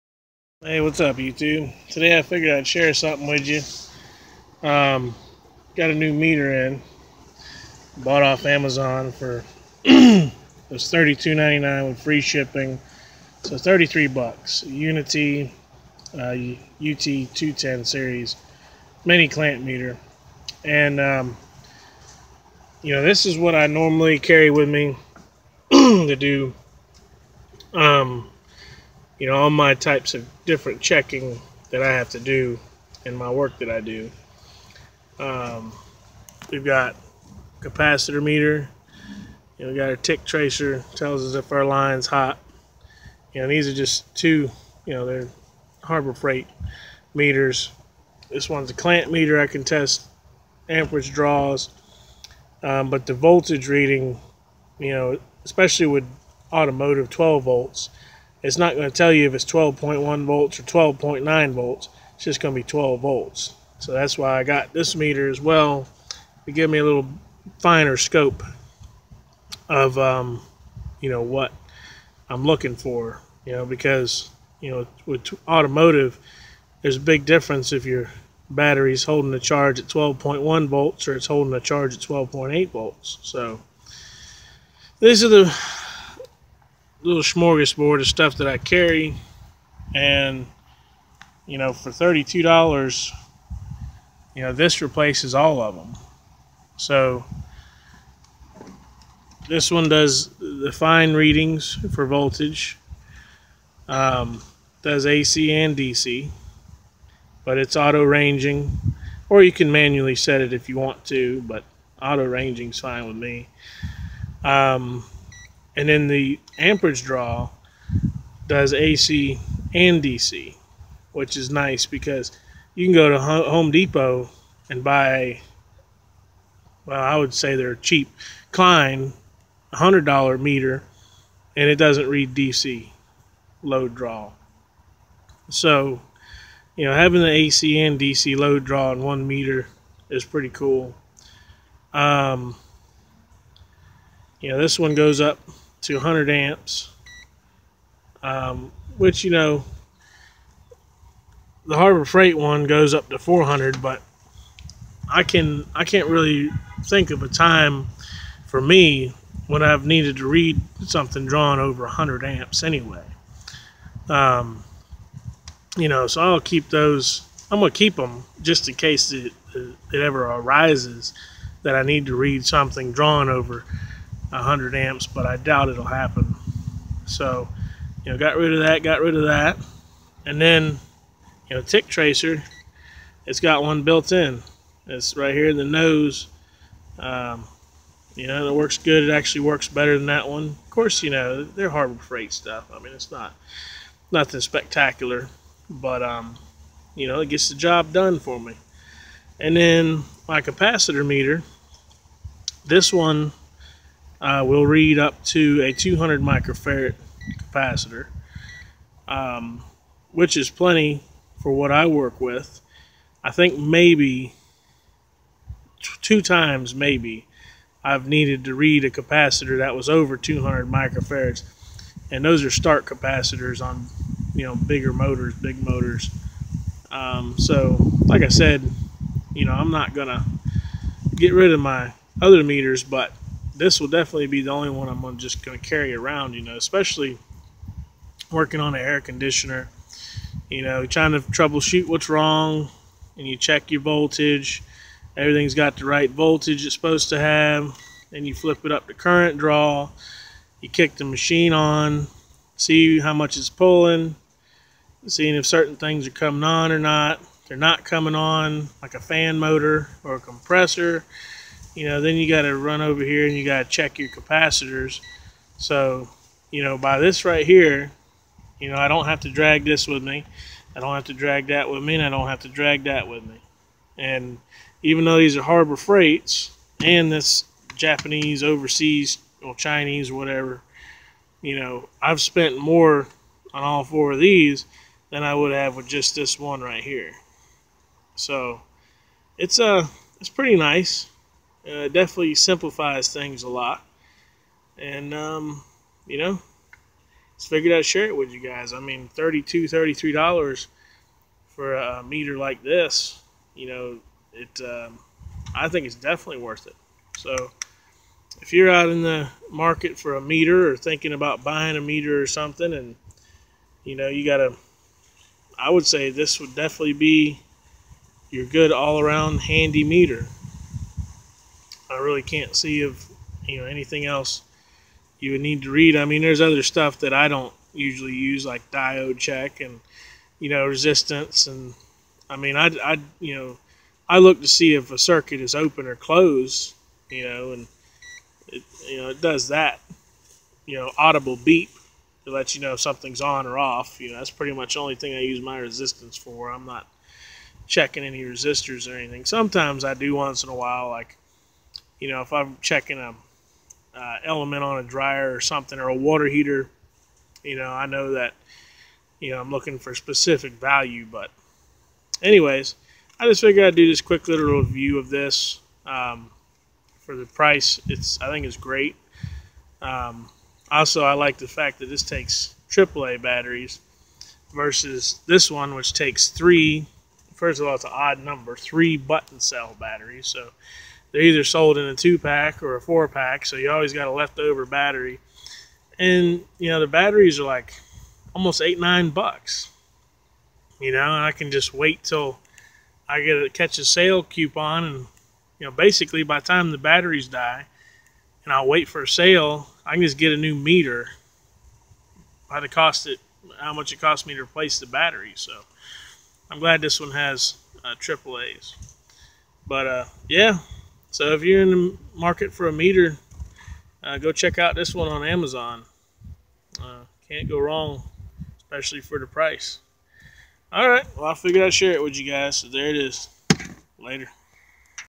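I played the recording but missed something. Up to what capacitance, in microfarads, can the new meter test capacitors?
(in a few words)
200 microfarads.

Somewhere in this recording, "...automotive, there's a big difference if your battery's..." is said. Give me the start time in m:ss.
1:15.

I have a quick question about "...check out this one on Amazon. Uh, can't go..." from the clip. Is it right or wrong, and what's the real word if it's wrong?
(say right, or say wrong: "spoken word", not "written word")
right.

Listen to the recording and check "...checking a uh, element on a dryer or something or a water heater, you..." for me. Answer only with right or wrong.
right.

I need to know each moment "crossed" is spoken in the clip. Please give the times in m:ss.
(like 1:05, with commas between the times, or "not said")
not said.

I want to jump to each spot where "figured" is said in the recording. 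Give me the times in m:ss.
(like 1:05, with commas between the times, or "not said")
0:02, 4:57, 6:03, 7:01.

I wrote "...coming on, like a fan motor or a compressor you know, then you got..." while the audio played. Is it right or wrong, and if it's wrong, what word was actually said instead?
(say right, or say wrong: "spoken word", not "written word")
right.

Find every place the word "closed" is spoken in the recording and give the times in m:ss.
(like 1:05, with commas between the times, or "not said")
5:35.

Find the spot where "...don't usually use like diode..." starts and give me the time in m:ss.
5:27.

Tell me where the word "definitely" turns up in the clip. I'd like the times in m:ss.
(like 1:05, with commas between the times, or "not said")
3:53, 4:51, 5:05, 5:16.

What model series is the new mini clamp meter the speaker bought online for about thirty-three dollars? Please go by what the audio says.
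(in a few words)
UT210.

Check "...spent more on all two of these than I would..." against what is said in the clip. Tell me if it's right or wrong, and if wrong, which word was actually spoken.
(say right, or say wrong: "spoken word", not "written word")
wrong: "four", not "two".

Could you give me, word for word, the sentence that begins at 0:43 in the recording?
You know, these are just two.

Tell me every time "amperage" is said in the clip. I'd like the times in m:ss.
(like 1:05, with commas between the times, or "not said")
0:50, 1:56.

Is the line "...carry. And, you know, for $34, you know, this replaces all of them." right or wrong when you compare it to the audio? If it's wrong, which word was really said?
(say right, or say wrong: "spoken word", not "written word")
wrong: "32", not "34".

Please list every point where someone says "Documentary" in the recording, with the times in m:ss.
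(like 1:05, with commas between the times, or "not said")
not said.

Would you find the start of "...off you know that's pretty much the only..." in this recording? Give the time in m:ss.
5:43.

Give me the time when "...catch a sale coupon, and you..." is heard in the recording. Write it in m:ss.
6:33.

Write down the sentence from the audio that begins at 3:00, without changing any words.
And then, you know, Tick Tracer, it's got one built in.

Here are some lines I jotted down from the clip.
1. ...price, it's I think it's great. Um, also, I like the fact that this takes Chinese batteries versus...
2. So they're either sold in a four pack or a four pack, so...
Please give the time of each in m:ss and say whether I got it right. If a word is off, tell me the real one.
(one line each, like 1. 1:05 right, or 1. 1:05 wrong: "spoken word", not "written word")
1. 6:07 wrong: "AAA", not "Chinese"
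2. 6:20 wrong: "two", not "four".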